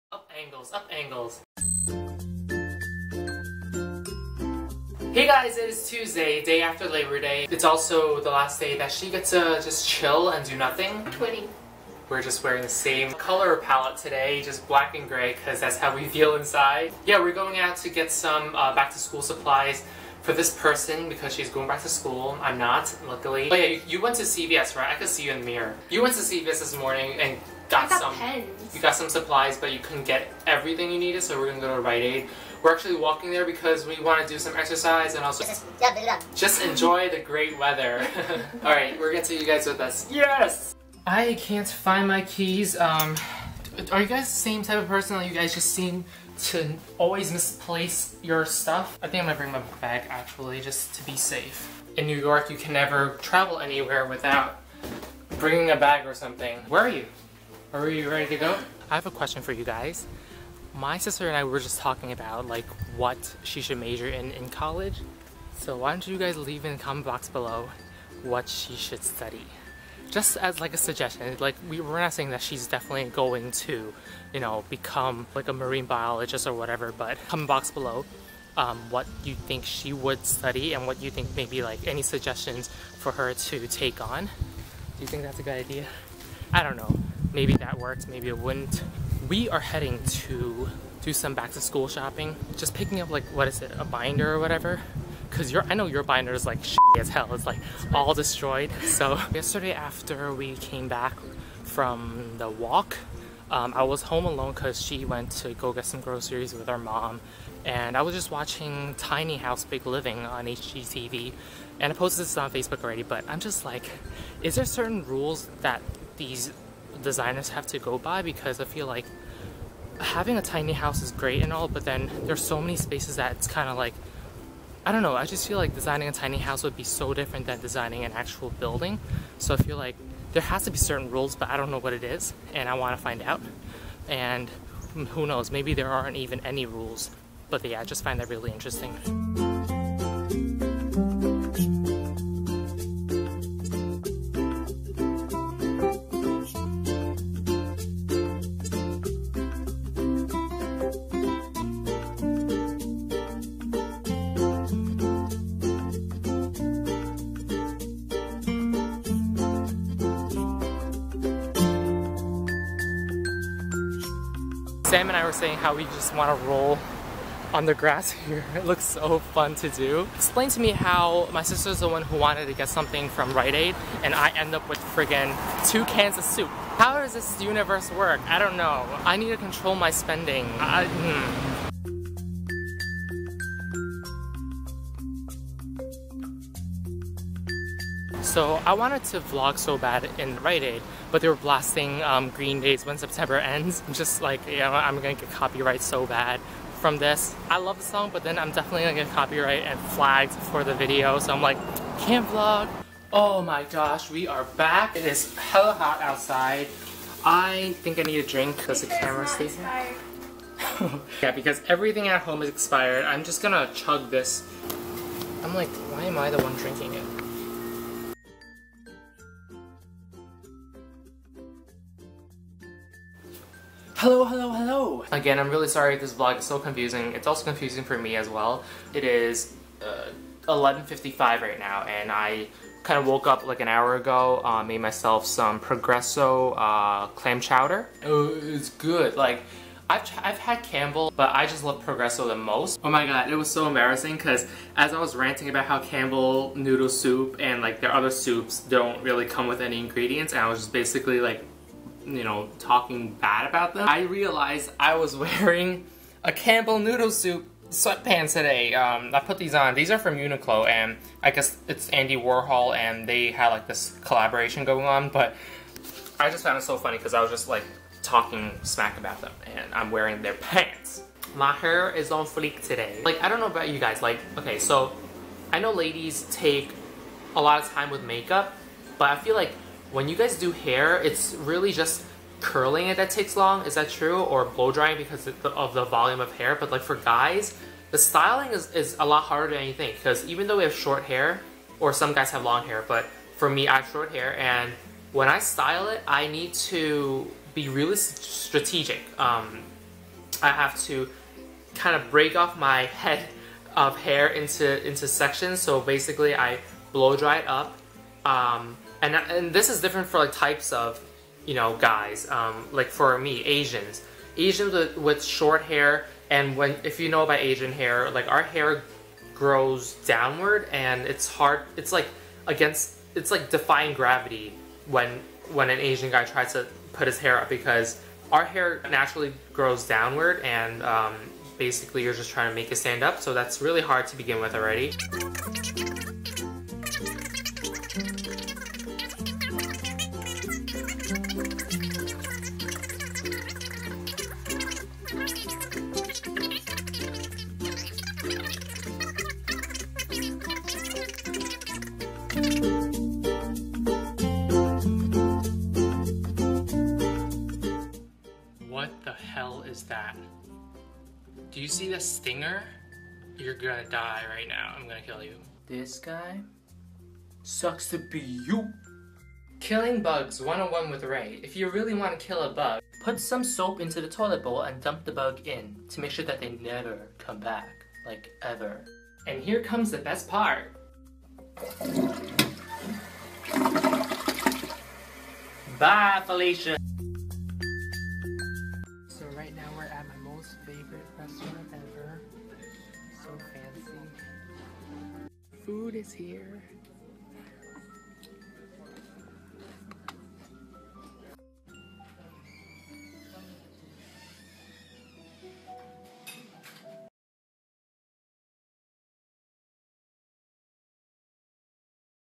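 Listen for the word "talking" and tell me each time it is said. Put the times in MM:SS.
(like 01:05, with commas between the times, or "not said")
01:01, 04:12, 04:28.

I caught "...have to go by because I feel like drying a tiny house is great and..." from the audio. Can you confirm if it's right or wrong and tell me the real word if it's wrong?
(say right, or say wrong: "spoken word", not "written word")
wrong: "having", not "drying".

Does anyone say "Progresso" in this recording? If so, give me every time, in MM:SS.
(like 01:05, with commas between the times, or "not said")
03:55, 04:01.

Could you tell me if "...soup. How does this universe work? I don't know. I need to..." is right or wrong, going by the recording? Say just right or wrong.
right.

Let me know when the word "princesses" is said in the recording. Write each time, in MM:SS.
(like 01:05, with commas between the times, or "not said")
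not said.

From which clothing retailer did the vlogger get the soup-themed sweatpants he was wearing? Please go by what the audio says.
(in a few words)
Uniqlo.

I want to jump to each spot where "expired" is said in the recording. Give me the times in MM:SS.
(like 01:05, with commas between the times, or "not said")
03:32.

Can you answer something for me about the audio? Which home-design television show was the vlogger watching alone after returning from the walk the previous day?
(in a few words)
Tiny House Big Living.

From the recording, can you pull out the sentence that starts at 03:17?
I love the song, but then I'm definitely gonna get copyright and flagged for the video, so I'm like, can't vlog.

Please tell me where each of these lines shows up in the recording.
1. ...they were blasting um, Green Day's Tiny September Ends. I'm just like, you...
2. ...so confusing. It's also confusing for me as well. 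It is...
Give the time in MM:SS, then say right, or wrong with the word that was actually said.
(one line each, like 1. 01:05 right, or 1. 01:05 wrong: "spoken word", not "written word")
1. 03:11 wrong: "When", not "Tiny"
2. 03:46 right.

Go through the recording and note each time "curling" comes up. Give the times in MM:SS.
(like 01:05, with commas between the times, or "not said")
04:42.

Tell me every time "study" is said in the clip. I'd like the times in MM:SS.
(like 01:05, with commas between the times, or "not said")
01:09, 01:20.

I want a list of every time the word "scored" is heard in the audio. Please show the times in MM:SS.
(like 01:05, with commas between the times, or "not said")
not said.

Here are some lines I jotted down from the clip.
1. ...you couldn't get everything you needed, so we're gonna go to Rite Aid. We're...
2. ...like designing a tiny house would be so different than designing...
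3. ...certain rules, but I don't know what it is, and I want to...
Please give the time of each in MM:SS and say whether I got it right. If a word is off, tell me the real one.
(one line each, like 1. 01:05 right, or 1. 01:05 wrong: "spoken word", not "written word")
1. 00:29 right
2. 02:05 right
3. 02:10 right.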